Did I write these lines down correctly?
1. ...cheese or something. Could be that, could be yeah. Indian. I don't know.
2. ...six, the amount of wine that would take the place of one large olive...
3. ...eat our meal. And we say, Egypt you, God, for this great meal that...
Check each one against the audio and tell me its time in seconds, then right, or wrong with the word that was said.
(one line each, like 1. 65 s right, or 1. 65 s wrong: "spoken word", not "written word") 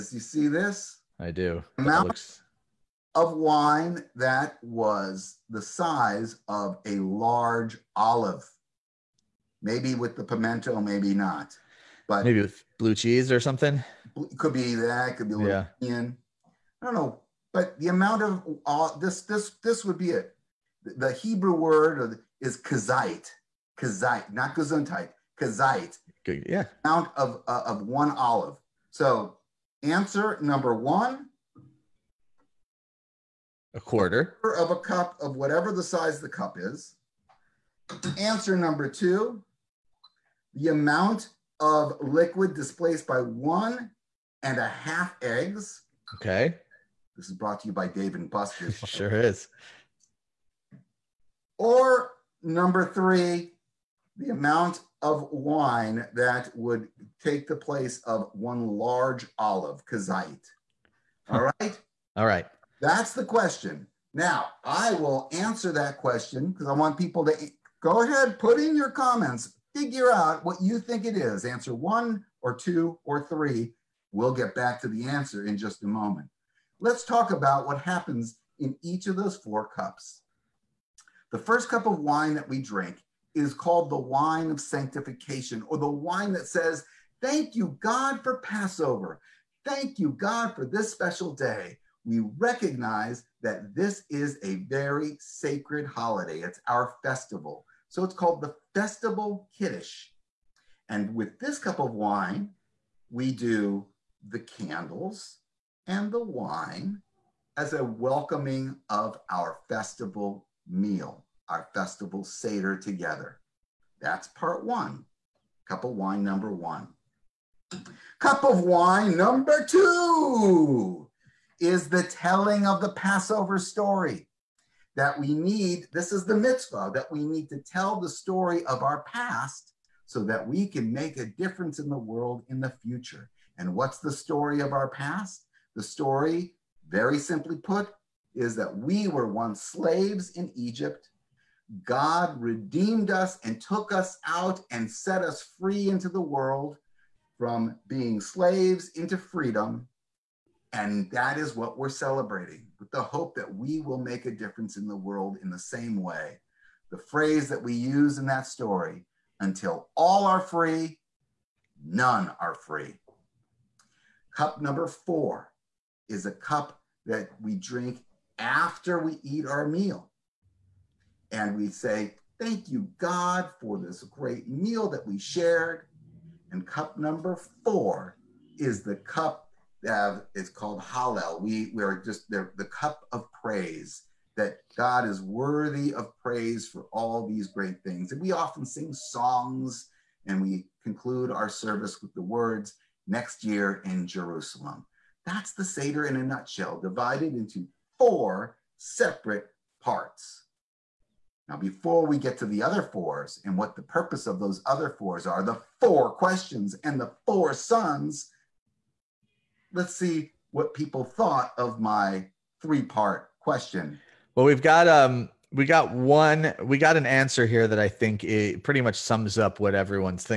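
1. 12 s right
2. 52 s wrong: "three", not "six"
3. 169 s wrong: "Thank", not "Egypt".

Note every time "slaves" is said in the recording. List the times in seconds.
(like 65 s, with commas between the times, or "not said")
139 s, 148 s.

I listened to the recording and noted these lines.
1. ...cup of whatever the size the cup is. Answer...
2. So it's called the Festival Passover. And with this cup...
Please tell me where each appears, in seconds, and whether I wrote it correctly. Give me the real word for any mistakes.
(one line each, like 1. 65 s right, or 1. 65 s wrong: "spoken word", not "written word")
1. 34 s right
2. 97 s wrong: "Kiddush", not "Passover".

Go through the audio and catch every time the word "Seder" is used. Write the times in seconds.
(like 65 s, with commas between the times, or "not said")
112 s, 195 s.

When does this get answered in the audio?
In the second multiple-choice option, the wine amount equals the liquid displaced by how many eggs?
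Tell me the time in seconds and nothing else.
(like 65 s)
43 s.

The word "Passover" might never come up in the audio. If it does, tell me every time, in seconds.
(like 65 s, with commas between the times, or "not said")
88 s, 122 s.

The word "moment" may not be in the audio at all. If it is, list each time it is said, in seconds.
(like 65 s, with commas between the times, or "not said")
75 s.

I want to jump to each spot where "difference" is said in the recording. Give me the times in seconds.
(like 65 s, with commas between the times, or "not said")
131 s, 154 s.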